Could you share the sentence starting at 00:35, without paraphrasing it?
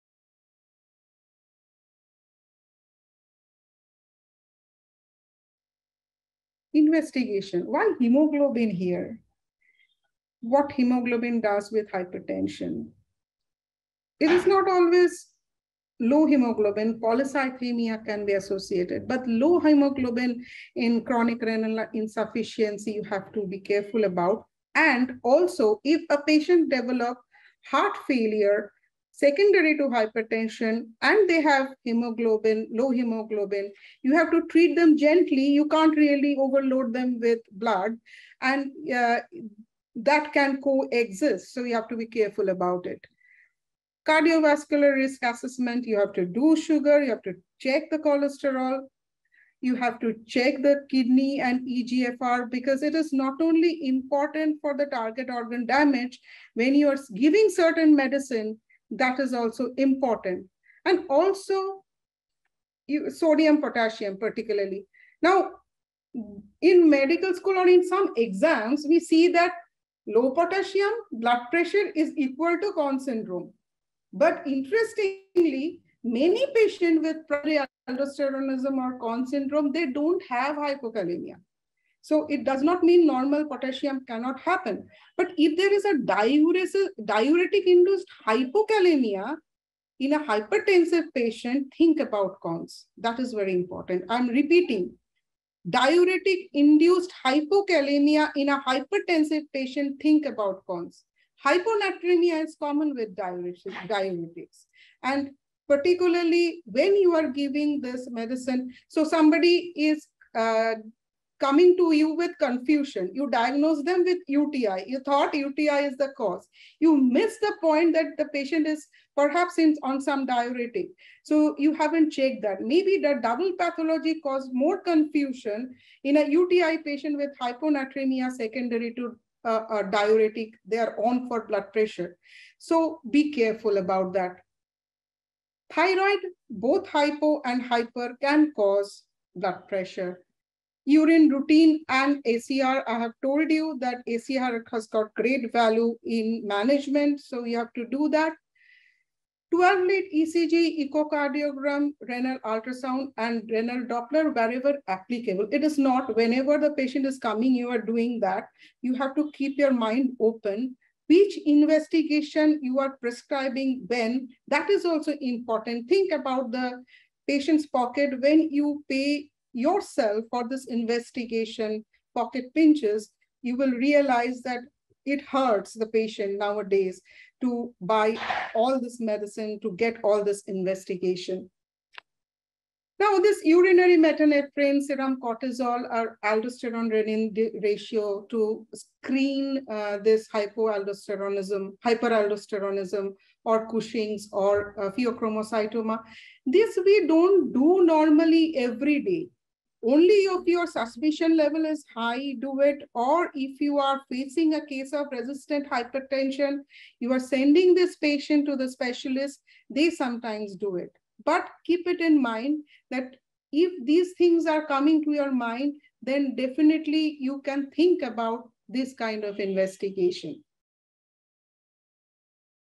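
You can't really overload them with blood.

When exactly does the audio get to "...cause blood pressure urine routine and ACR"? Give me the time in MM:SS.
02:18.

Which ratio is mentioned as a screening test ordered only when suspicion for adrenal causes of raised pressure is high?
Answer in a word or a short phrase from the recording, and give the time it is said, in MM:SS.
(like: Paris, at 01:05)
aldosterone-renin ratio, at 03:06.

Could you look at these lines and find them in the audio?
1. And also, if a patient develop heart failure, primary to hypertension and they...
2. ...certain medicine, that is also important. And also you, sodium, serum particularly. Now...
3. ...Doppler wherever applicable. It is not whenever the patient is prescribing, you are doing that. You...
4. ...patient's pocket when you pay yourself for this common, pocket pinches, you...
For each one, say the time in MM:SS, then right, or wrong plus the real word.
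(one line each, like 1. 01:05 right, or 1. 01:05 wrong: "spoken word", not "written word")
1. 00:24 wrong: "secondary", not "primary"
2. 00:57 wrong: "potassium", not "serum"
3. 02:33 wrong: "coming", not "prescribing"
4. 02:47 wrong: "investigation", not "common".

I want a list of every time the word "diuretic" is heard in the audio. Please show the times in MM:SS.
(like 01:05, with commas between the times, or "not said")
01:27, 01:35, 01:43, 02:00, 02:09.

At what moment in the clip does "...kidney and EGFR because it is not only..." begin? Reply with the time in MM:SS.
00:50.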